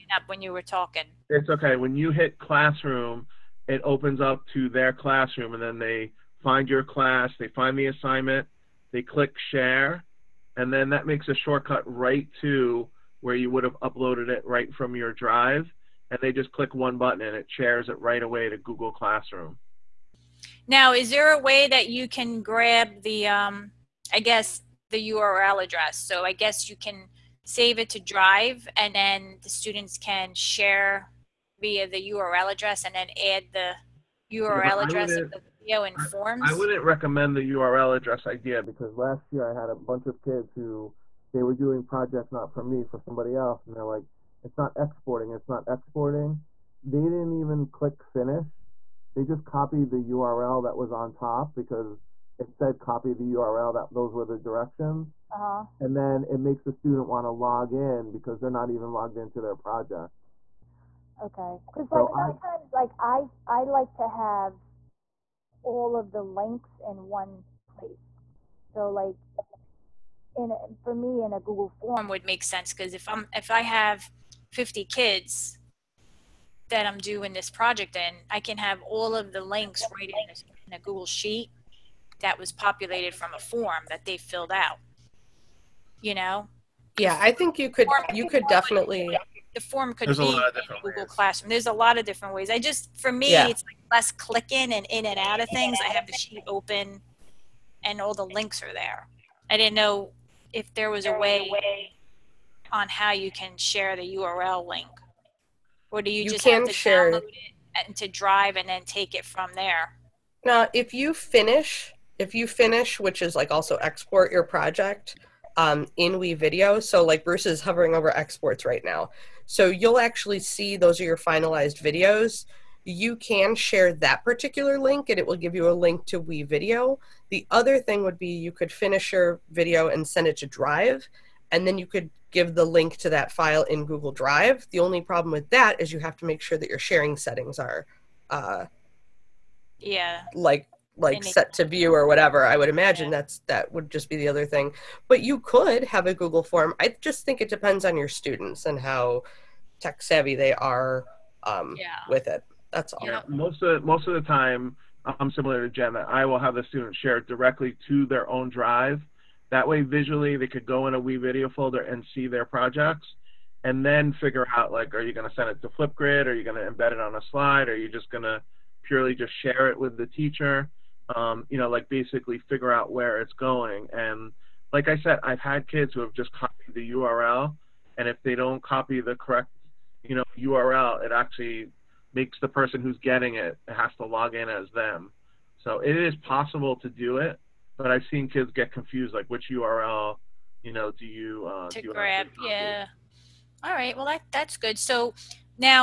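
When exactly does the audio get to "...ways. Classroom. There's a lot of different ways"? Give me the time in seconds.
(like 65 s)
91 s.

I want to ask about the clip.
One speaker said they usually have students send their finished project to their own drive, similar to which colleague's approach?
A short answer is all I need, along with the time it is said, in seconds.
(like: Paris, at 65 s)
Jen, at 155 s.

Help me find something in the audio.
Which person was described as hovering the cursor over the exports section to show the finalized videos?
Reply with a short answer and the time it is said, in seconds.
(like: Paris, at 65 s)
Bruce, at 117 s.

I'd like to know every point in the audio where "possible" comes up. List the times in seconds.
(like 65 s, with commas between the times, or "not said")
186 s.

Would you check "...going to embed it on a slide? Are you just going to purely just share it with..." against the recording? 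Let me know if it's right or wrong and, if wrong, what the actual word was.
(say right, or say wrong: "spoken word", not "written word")
right.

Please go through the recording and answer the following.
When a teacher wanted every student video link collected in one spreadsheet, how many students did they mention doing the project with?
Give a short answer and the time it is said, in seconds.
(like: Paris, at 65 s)
50, at 74 s.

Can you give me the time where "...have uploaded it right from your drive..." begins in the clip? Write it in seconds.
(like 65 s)
13 s.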